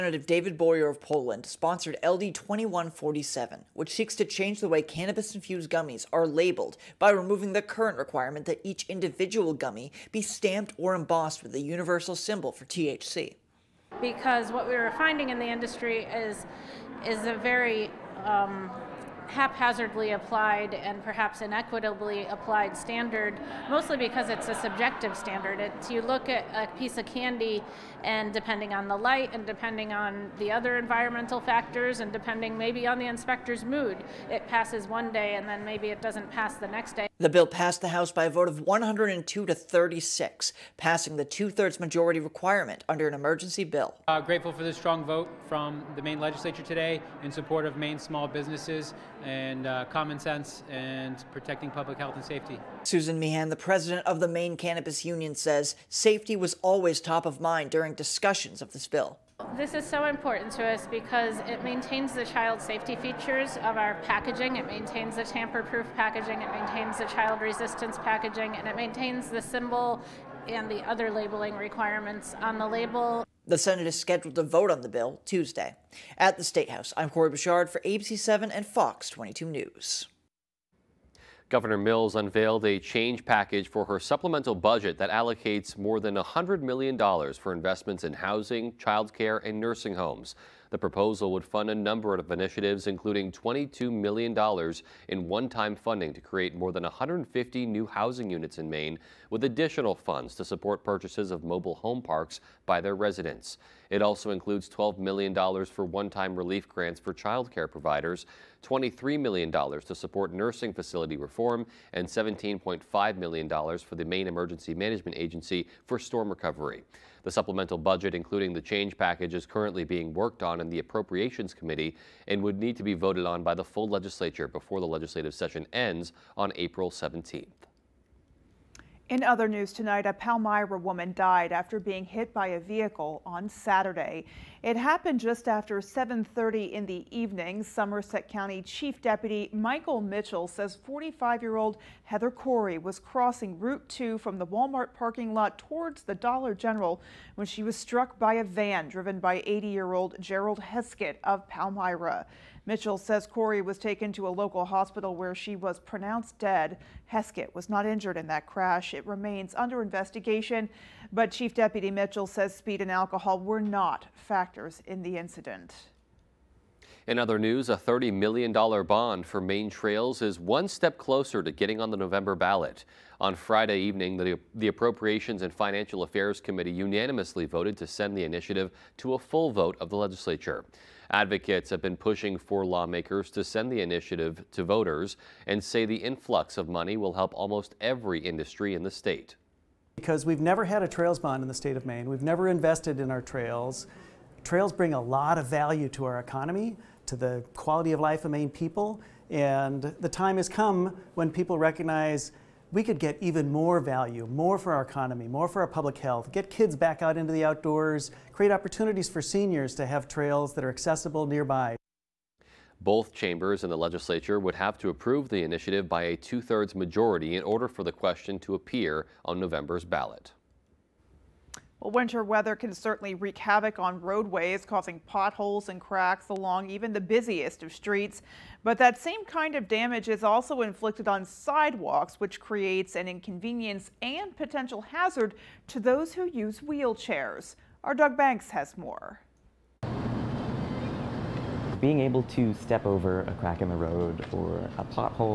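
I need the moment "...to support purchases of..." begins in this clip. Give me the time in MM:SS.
01:40.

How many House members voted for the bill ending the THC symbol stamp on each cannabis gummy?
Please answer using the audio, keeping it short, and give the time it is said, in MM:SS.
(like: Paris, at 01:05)
102, at 00:38.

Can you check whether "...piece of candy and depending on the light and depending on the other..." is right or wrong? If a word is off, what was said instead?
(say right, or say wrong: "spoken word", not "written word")
right.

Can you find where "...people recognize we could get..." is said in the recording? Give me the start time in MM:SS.
03:21.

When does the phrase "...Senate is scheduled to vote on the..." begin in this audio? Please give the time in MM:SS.
01:13.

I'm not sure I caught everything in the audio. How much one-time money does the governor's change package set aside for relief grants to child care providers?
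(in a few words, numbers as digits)
$12 million.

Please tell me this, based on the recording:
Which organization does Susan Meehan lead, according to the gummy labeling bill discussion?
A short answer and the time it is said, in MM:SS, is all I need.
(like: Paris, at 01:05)
Maine Cannabis Union, at 00:54.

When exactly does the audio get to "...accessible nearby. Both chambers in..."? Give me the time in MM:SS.
03:30.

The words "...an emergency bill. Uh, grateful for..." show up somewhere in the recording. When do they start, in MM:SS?
00:43.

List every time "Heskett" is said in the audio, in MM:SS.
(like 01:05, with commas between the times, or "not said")
02:30, 02:37.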